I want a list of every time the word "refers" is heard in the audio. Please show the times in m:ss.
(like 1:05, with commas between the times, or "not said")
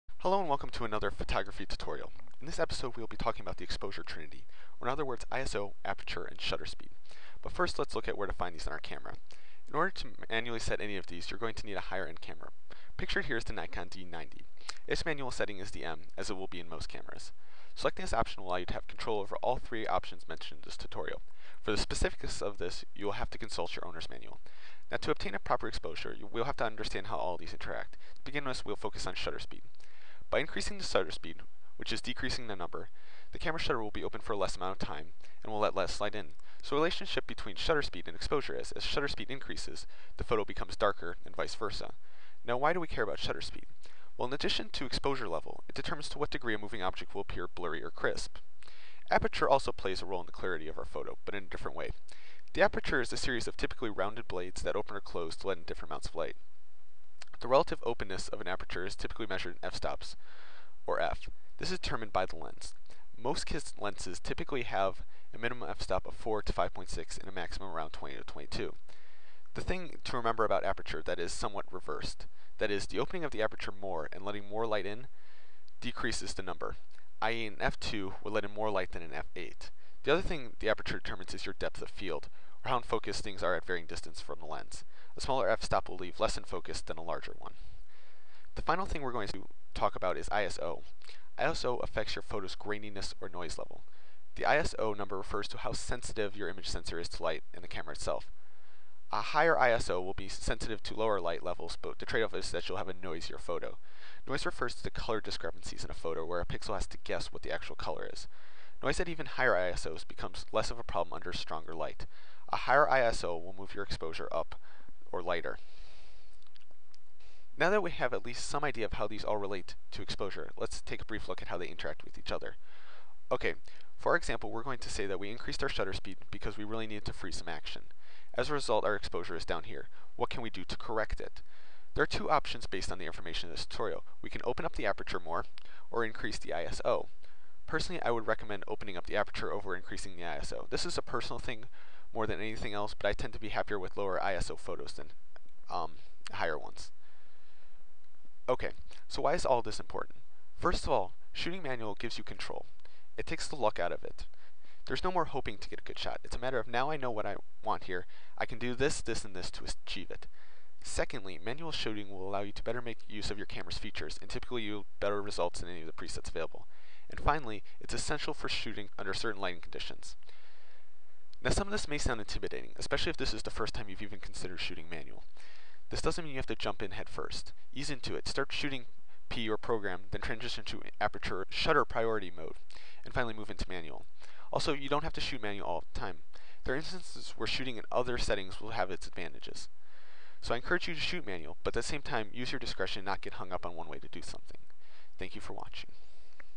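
1:35, 1:44.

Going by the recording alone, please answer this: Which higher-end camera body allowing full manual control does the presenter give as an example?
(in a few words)
Nikon D90.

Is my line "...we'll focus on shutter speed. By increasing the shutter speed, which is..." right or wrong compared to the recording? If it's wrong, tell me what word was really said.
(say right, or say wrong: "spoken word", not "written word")
right.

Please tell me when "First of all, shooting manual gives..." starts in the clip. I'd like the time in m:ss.
2:30.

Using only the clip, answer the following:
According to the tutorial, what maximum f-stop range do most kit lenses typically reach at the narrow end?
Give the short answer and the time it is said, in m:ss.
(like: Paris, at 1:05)
20 to 22, at 1:07.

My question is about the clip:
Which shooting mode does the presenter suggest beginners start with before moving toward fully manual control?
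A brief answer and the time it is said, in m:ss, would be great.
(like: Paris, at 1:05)
Program, at 2:59.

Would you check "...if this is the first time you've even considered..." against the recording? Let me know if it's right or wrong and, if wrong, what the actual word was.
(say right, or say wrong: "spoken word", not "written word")
right.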